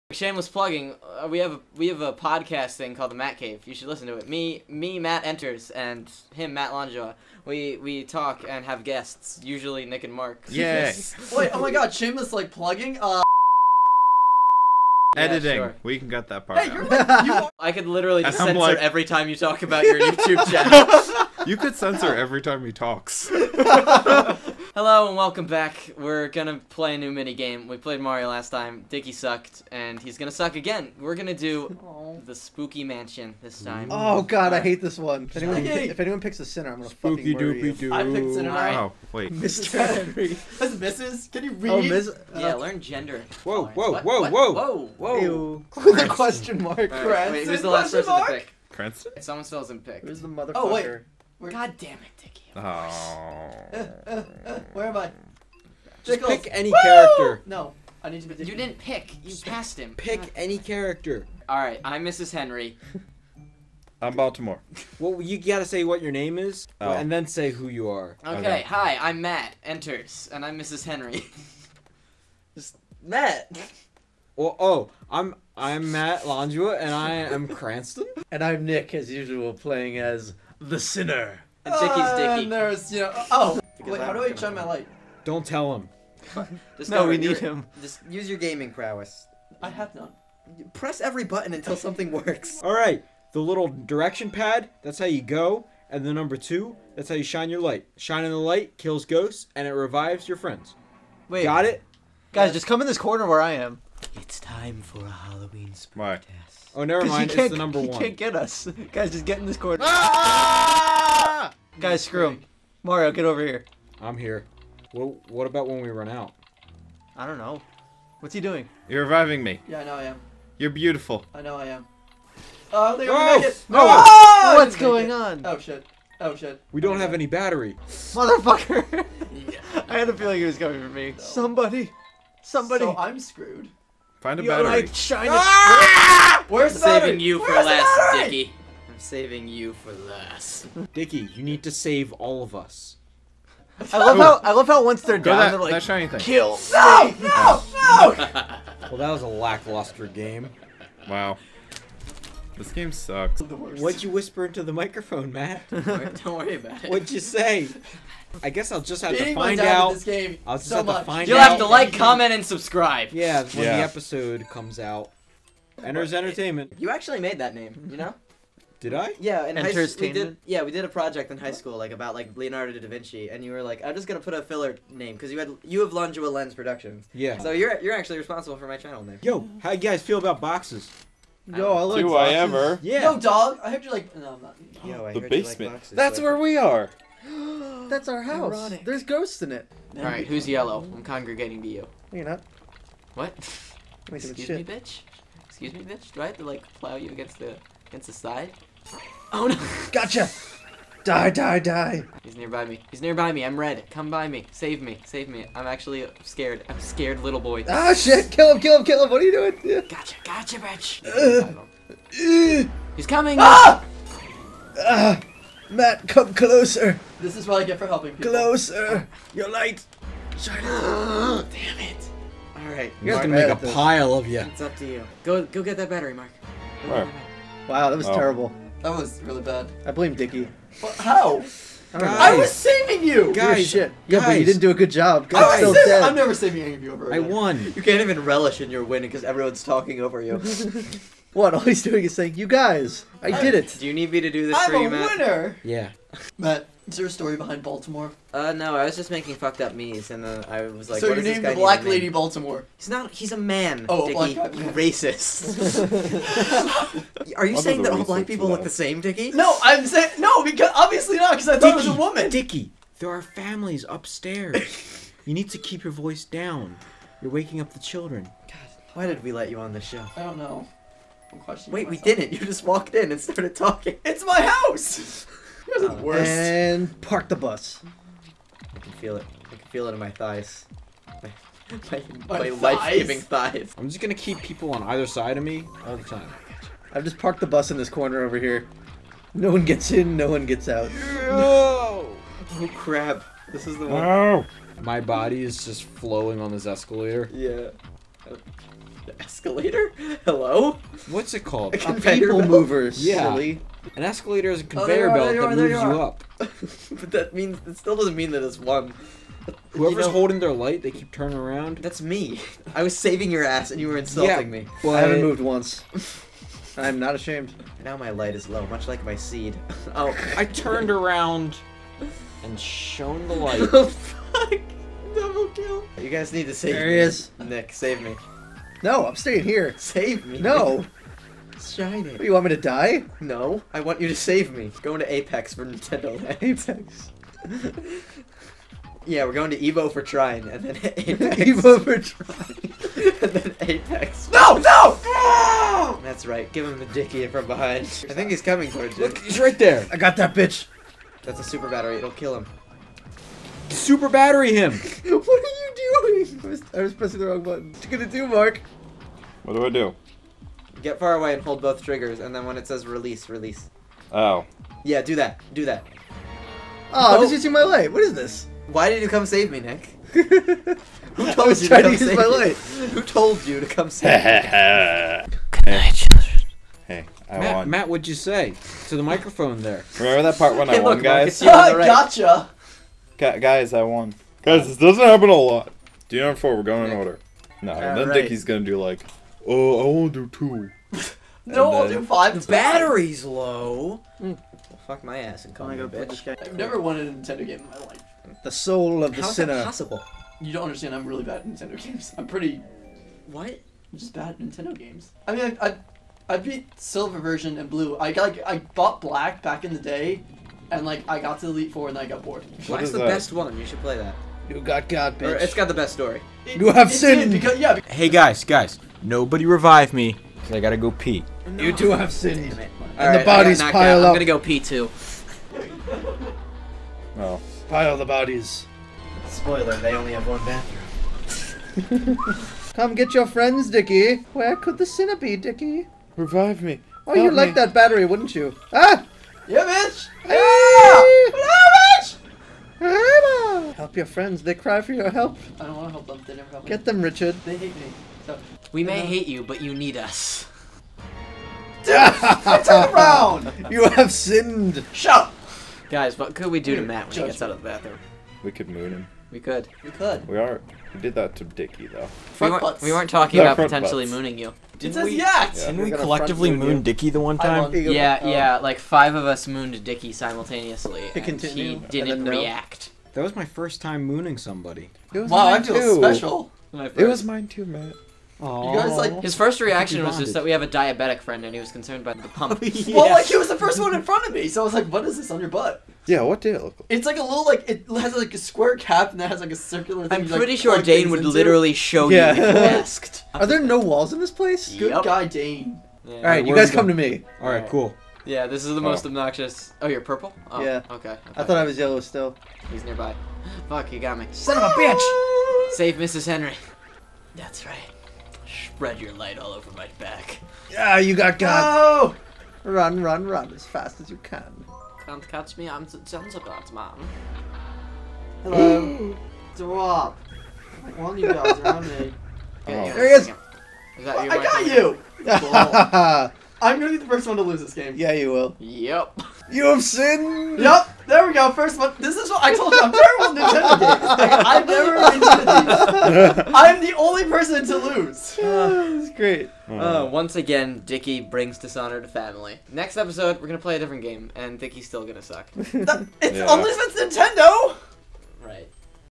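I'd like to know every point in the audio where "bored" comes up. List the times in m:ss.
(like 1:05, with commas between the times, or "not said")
6:52.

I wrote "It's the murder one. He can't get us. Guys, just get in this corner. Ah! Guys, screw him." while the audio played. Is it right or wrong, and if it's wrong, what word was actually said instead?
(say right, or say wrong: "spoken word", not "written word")
wrong: "number", not "murder".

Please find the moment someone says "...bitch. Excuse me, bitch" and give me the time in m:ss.
3:14.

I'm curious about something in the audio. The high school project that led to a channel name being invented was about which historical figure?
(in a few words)
Leonardo da Vinci.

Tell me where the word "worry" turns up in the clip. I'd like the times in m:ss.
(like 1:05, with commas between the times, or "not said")
2:36.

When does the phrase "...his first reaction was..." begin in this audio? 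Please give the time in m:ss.
7:59.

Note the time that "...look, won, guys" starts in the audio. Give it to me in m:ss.
6:20.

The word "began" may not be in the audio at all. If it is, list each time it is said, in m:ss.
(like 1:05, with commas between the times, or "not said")
not said.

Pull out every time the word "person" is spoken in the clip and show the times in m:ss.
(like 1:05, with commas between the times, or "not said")
0:48, 8:57.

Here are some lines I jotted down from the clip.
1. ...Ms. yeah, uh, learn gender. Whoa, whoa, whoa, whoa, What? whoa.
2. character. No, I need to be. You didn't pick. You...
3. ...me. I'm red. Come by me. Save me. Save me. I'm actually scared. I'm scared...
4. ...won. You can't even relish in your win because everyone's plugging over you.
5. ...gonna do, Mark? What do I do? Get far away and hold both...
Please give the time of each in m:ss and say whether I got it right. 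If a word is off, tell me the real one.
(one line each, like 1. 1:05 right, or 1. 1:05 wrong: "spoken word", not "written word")
1. 0:41 right
2. 0:56 right
3. 3:23 right
4. 3:57 wrong: "talking", not "plugging"
5. 5:57 right.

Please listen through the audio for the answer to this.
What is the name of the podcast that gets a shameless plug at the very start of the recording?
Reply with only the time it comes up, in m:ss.
0:03.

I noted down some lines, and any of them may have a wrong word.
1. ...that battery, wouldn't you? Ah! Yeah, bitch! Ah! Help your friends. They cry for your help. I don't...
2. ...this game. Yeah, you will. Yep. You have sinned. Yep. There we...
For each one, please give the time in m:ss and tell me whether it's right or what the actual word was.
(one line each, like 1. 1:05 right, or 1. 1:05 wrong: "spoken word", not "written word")
1. 7:17 right
2. 8:47 right.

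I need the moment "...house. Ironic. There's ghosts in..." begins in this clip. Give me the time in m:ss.
3:08.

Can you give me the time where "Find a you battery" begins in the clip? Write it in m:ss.
2:14.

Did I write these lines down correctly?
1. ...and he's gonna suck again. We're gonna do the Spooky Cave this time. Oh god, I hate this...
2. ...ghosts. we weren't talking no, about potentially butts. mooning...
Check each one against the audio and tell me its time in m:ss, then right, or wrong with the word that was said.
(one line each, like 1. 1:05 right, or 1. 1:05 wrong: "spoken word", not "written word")
1. 0:29 wrong: "Mansion", not "Cave"
2. 7:42 wrong: "butts", not "ghosts".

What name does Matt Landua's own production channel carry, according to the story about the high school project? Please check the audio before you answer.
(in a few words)
Longua Lens Productions.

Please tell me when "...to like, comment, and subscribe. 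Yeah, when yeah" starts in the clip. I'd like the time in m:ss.
2:41.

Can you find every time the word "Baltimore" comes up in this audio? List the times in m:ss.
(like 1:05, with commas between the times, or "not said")
1:04, 4:07, 4:12.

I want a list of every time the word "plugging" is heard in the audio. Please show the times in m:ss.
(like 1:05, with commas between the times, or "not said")
0:00, 0:12.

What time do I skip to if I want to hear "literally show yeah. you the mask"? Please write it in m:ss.
8:11.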